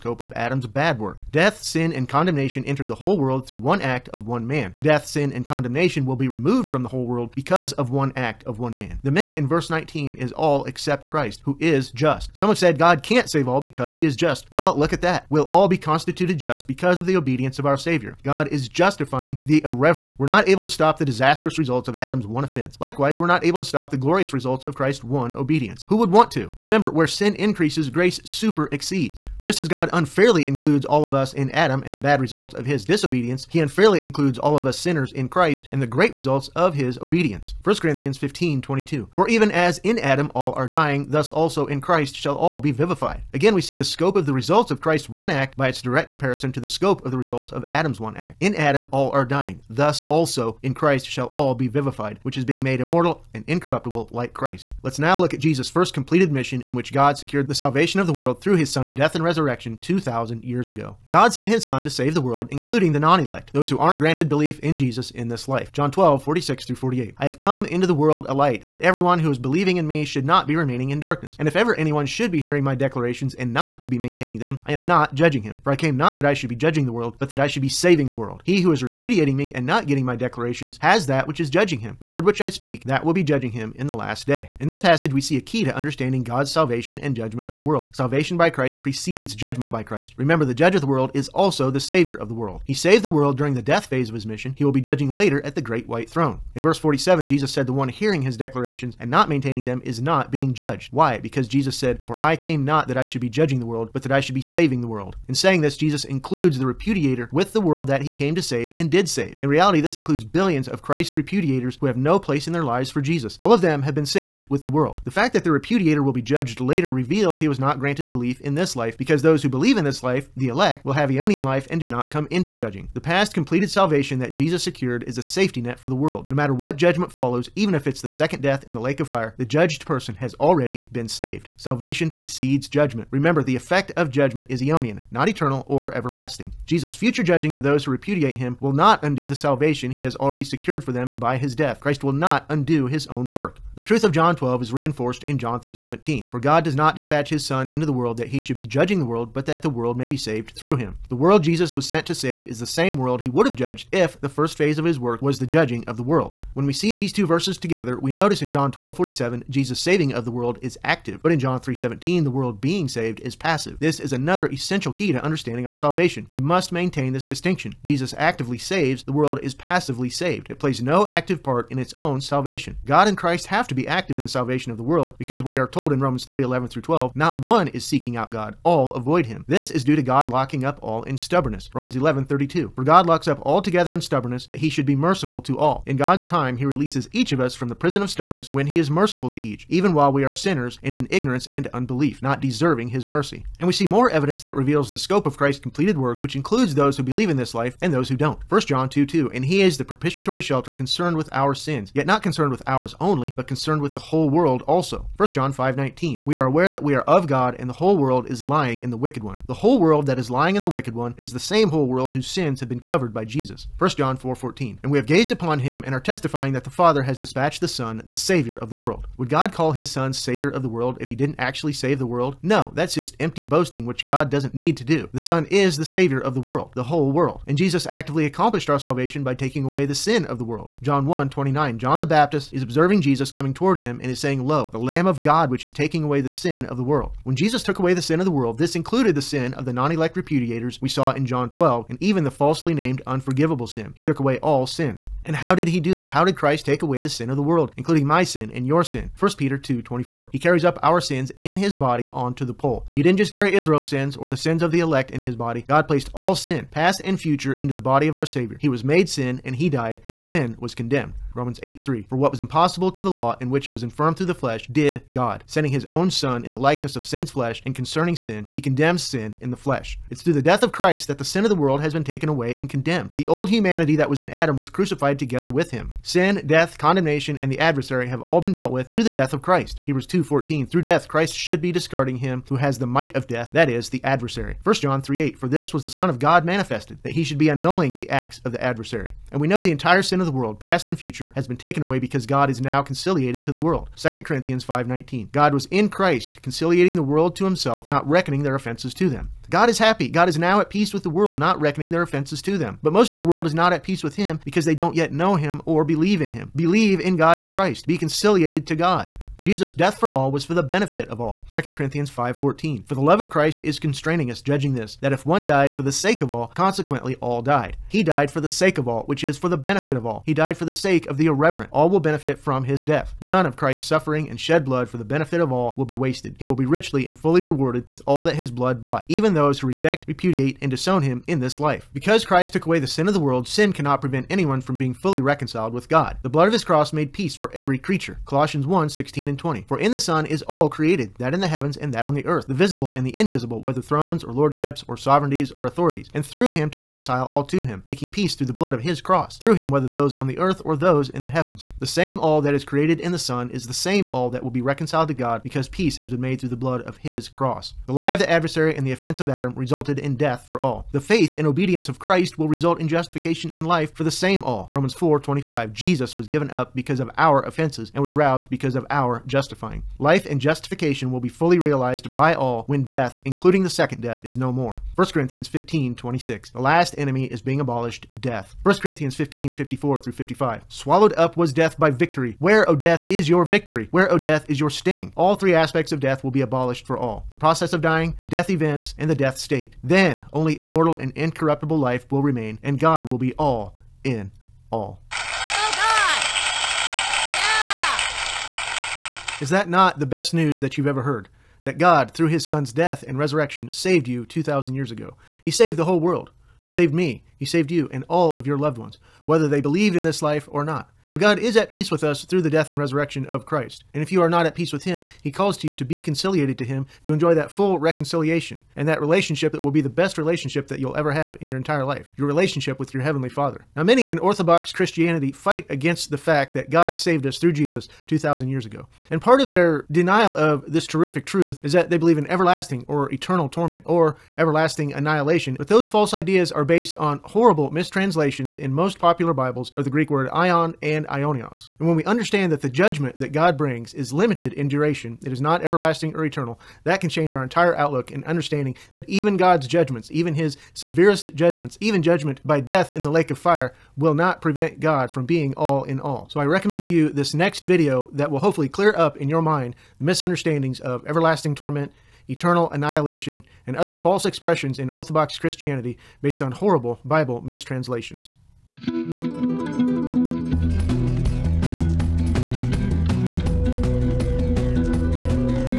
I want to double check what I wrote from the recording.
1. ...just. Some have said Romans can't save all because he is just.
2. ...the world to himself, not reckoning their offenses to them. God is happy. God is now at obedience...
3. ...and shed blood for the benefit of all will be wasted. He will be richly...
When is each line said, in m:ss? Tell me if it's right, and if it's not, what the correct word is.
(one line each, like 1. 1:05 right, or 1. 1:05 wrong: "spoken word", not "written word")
1. 0:11 wrong: "God", not "Romans"
2. 4:56 wrong: "peace", not "obedience"
3. 5:24 right.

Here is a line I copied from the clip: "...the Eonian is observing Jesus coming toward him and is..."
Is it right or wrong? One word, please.
wrong.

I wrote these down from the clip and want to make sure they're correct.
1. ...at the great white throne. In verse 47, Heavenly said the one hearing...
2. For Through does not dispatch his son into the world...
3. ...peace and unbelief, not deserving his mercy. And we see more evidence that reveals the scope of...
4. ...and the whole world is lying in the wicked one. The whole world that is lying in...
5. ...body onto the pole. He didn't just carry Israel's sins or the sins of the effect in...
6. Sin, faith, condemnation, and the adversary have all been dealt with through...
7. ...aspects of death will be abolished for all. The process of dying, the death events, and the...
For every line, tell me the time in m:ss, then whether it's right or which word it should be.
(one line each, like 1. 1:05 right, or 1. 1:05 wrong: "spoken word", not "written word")
1. 1:35 wrong: "Jesus", not "Heavenly"
2. 2:26 wrong: "God", not "Through"
3. 3:11 wrong: "ignorance", not "peace"
4. 3:27 right
5. 4:11 wrong: "elect", not "effect"
6. 4:36 wrong: "death", not "faith"
7. 6:25 right.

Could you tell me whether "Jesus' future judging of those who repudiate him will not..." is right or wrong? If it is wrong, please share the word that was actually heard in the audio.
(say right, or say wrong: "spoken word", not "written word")
right.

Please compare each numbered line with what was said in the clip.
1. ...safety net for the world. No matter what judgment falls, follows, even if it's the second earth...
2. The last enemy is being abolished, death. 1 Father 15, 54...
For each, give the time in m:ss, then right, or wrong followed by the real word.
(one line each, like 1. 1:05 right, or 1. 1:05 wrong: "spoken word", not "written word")
1. 2:05 wrong: "death", not "earth"
2. 6:16 wrong: "Corinthians", not "Father".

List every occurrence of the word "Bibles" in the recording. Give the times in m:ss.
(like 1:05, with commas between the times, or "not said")
7:19, 7:47.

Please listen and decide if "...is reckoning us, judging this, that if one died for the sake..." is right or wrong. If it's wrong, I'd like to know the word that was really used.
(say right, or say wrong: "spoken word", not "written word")
wrong: "constraining", not "reckoning".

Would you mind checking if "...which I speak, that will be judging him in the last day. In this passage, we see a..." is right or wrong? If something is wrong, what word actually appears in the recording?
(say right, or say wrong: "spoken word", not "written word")
right.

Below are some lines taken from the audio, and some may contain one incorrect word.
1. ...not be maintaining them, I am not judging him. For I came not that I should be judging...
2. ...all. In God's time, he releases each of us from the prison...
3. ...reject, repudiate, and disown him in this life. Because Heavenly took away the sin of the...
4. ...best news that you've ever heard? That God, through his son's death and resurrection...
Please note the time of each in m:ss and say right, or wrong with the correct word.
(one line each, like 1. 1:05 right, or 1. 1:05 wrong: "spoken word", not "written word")
1. 1:13 right
2. 3:05 right
3. 5:29 wrong: "Christ", not "Heavenly"
4. 6:40 right.